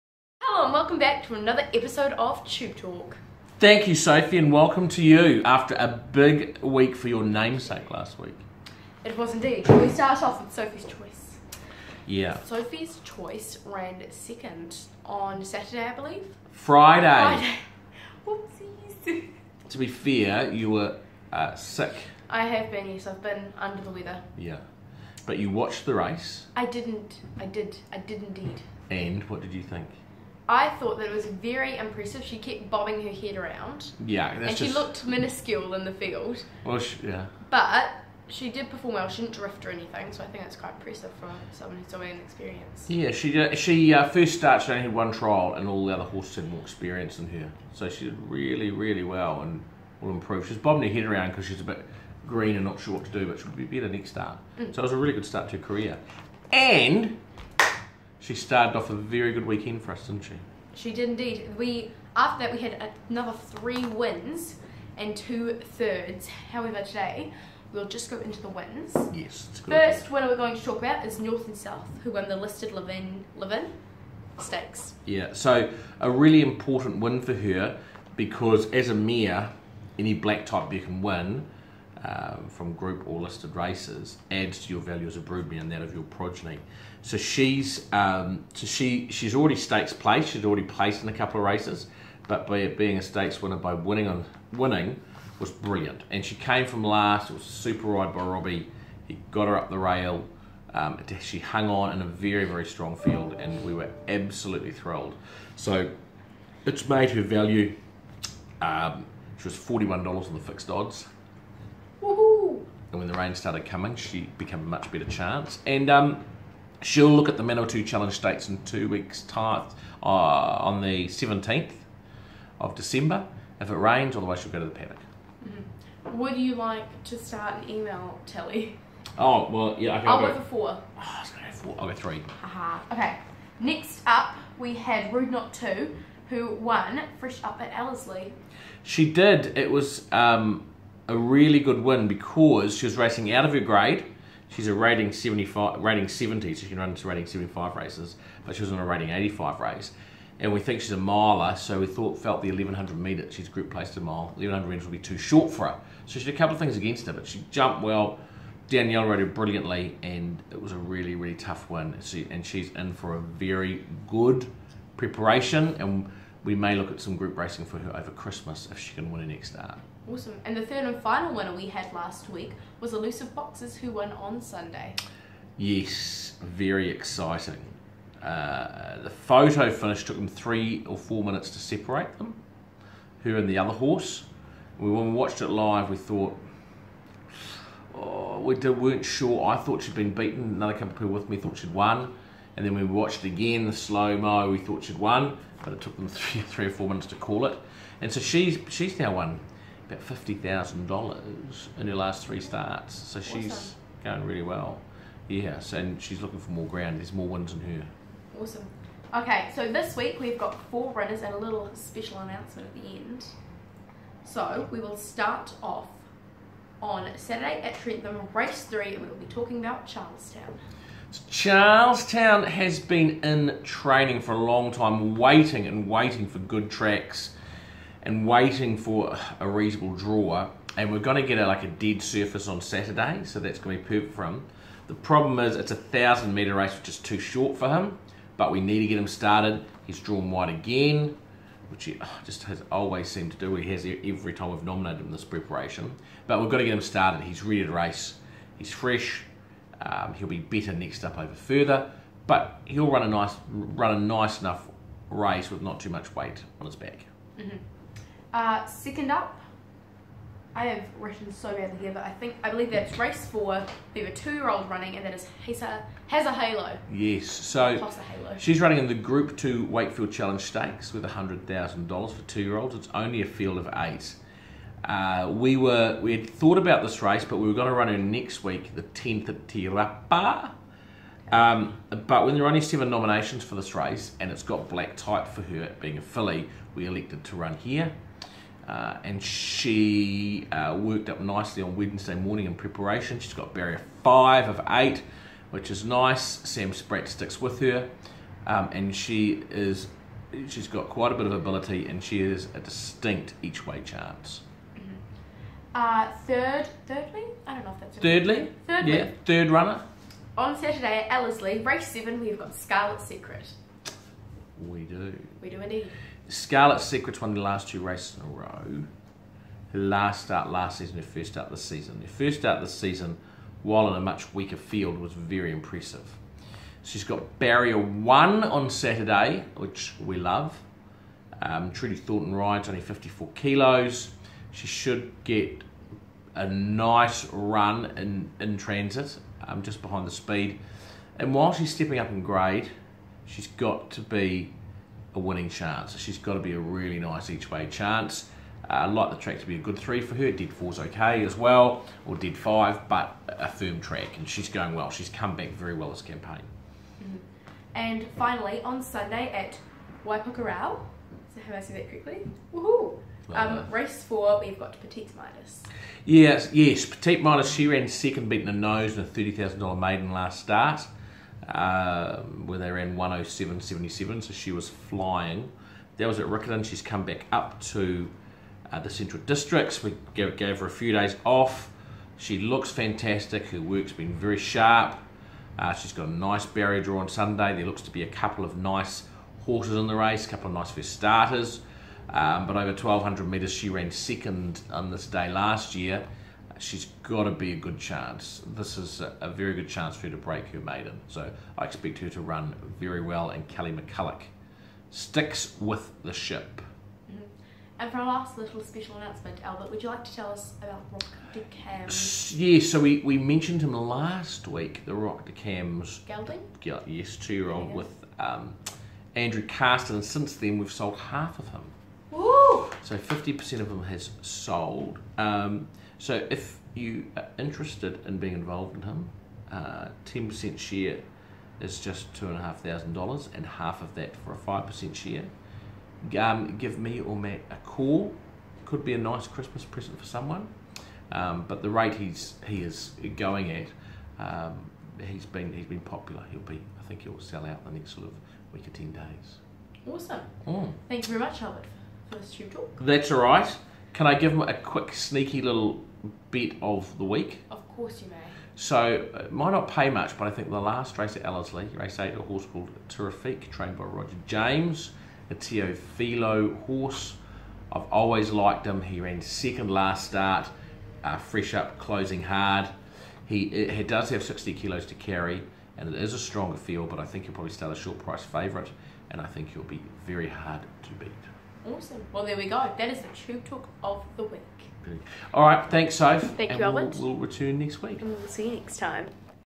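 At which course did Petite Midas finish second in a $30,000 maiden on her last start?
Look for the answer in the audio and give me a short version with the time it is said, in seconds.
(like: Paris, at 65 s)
Riccarton, at 376 s.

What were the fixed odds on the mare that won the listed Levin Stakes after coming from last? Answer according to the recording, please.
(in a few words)
$41.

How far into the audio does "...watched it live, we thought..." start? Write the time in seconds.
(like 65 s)
185 s.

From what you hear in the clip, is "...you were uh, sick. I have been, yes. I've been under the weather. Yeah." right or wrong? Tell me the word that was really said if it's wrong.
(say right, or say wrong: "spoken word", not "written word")
right.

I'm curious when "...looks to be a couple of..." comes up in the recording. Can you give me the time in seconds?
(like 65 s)
387 s.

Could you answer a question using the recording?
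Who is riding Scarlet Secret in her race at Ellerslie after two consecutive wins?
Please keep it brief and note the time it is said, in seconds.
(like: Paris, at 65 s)
Trudy Thornton, at 331 s.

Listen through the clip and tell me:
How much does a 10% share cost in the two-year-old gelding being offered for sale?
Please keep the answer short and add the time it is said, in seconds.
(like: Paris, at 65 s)
$2,500, at 432 s.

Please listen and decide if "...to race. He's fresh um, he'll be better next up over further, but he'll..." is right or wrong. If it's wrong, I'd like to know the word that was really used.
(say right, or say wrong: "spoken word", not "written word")
right.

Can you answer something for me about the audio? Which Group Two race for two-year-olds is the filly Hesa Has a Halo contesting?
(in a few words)
Wakefield Challenge Stakes.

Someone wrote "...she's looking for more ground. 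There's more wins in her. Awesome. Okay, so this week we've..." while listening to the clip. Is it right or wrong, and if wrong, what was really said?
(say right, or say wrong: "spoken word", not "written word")
right.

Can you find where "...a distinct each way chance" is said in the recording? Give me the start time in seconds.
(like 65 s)
302 s.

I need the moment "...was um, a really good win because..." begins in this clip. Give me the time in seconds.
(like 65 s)
139 s.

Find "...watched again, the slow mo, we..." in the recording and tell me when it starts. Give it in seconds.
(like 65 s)
192 s.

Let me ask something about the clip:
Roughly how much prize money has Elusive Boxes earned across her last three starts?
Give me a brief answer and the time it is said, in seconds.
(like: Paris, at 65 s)
$50,000, at 200 s.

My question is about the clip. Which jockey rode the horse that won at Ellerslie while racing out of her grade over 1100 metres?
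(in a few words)
Danielle.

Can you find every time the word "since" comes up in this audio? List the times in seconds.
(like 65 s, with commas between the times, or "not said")
420 s.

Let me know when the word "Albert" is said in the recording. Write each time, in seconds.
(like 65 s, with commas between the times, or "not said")
409 s, 451 s.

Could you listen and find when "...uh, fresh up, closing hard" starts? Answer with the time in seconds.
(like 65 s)
471 s.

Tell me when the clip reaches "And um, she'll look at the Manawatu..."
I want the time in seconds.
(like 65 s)
115 s.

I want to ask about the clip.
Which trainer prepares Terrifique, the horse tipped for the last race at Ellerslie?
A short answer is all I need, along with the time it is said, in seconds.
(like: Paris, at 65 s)
Roger James, at 463 s.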